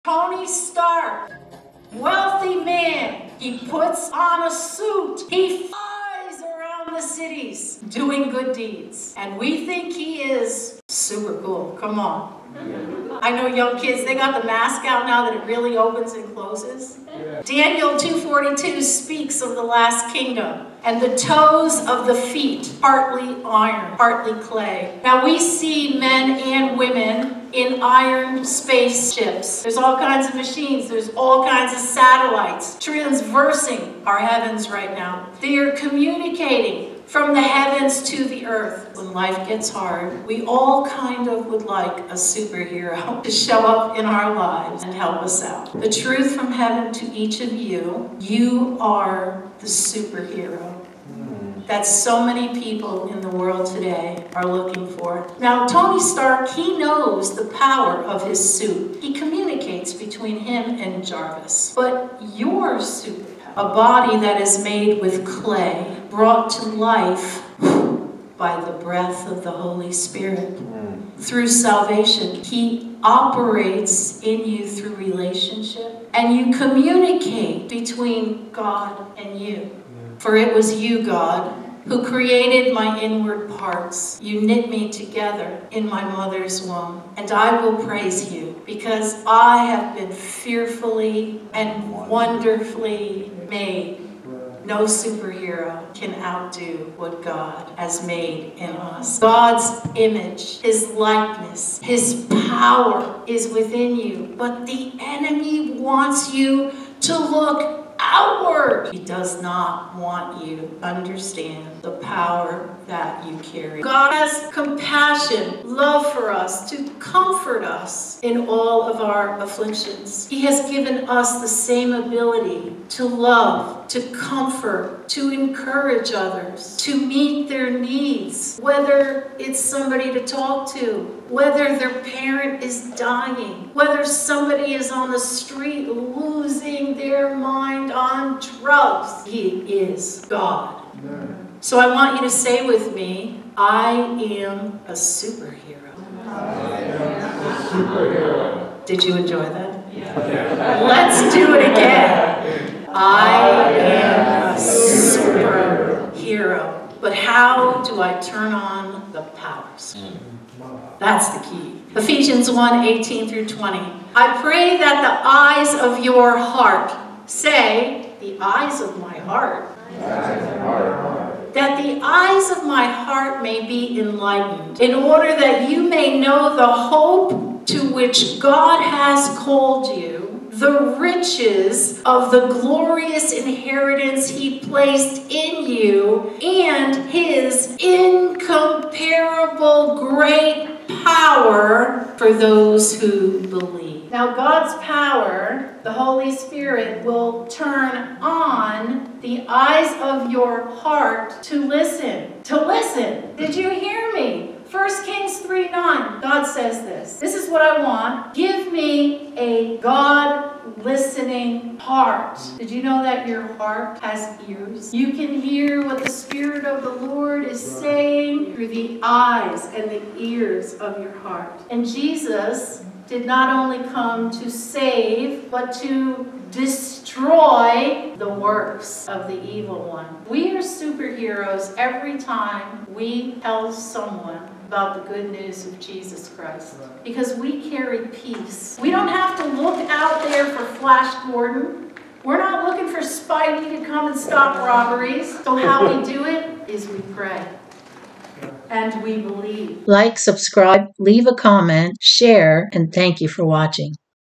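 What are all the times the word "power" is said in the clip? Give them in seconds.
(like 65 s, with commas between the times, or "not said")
57 s, 102 s, 111 s, 159 s, 194 s.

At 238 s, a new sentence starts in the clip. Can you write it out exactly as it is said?
We don't have to look out here for Flash Gordon.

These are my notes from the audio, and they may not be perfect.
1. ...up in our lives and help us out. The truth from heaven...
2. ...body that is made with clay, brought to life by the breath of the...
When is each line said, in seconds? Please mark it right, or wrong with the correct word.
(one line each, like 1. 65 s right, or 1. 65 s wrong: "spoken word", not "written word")
1. 43 s right
2. 63 s right.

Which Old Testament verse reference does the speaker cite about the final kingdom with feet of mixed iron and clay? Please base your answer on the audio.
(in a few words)
Daniel 2:42.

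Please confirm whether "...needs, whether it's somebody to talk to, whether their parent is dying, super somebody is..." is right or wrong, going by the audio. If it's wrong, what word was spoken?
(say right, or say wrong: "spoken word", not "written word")
wrong: "whether", not "super".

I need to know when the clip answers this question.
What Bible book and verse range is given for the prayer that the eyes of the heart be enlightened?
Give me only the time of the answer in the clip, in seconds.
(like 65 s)
161 s.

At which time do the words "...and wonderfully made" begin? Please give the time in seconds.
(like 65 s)
91 s.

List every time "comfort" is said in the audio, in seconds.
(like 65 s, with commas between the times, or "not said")
116 s, 124 s.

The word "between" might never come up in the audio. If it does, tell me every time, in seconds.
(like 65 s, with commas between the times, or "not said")
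59 s, 77 s.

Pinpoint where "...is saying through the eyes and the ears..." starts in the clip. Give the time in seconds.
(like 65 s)
217 s.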